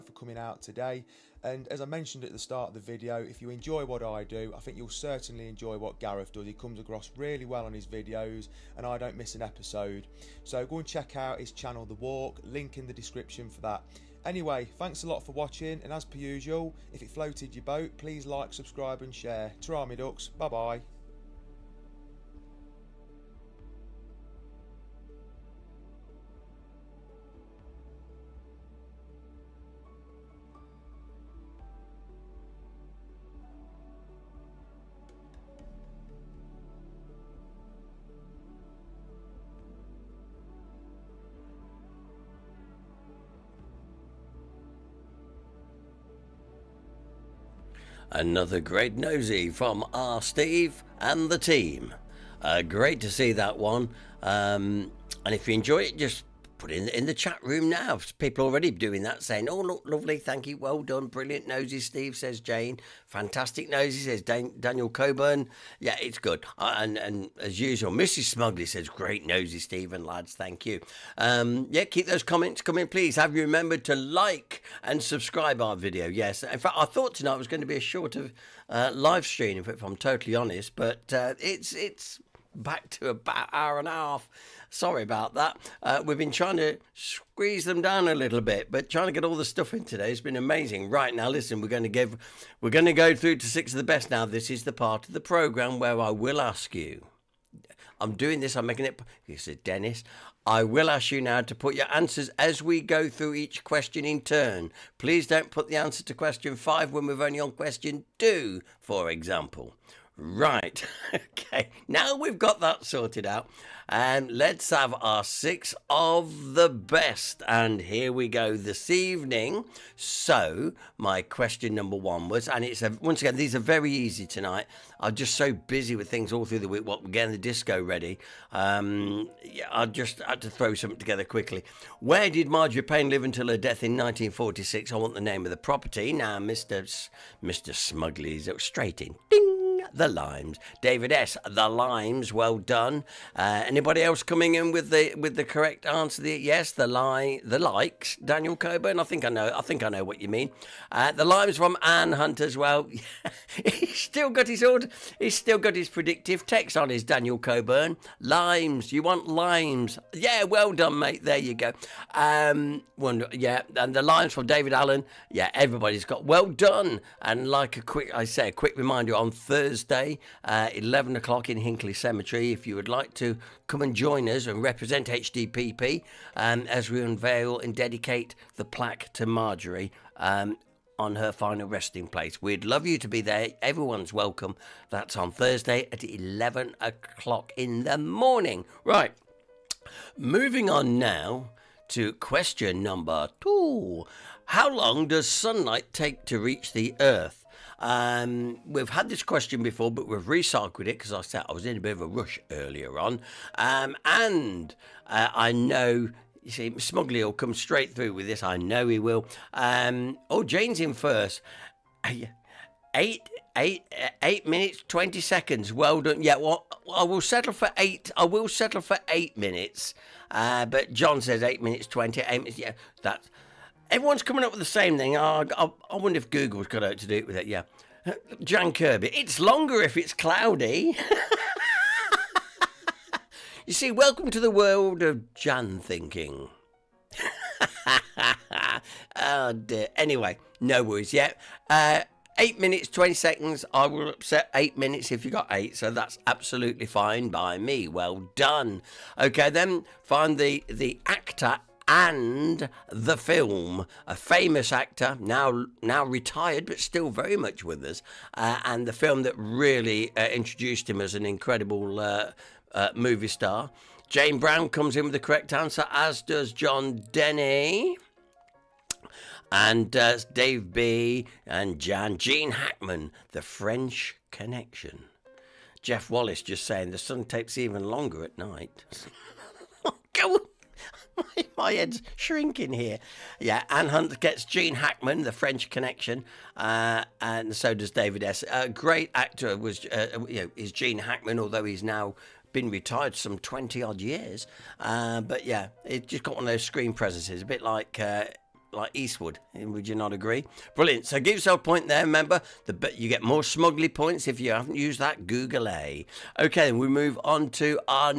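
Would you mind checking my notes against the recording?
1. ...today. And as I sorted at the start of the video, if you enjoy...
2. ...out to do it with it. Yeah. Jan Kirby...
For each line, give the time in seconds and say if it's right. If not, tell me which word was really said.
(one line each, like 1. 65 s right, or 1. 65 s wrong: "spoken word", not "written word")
1. 0 s wrong: "mentioned", not "sorted"
2. 226 s right.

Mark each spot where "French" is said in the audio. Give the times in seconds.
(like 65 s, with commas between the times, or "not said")
273 s, 285 s.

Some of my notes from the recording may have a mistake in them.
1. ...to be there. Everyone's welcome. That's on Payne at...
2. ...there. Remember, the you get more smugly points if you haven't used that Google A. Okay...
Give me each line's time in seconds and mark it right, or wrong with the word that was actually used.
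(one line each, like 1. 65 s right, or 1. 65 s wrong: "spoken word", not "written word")
1. 182 s wrong: "Thursday", not "Payne"
2. 301 s right.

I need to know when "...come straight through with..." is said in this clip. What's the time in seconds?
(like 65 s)
207 s.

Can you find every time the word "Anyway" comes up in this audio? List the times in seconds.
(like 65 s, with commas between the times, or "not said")
14 s, 239 s.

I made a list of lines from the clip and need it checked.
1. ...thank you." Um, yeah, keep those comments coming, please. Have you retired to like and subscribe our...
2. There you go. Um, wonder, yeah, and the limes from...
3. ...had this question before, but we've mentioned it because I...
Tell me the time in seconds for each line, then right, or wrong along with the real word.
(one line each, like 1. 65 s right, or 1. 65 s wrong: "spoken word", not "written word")
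1. 70 s wrong: "remembered", not "retired"
2. 161 s right
3. 198 s wrong: "recycled", not "mentioned".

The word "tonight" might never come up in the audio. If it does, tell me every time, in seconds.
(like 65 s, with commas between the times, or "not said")
77 s, 124 s.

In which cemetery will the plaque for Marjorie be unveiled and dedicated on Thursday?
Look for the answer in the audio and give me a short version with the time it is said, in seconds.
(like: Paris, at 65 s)
Hinckley Cemetery, at 171 s.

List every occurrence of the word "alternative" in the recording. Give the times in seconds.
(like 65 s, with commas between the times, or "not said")
not said.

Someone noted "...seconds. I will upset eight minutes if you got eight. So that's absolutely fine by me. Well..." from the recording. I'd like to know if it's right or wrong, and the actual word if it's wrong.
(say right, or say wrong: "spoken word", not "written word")
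right.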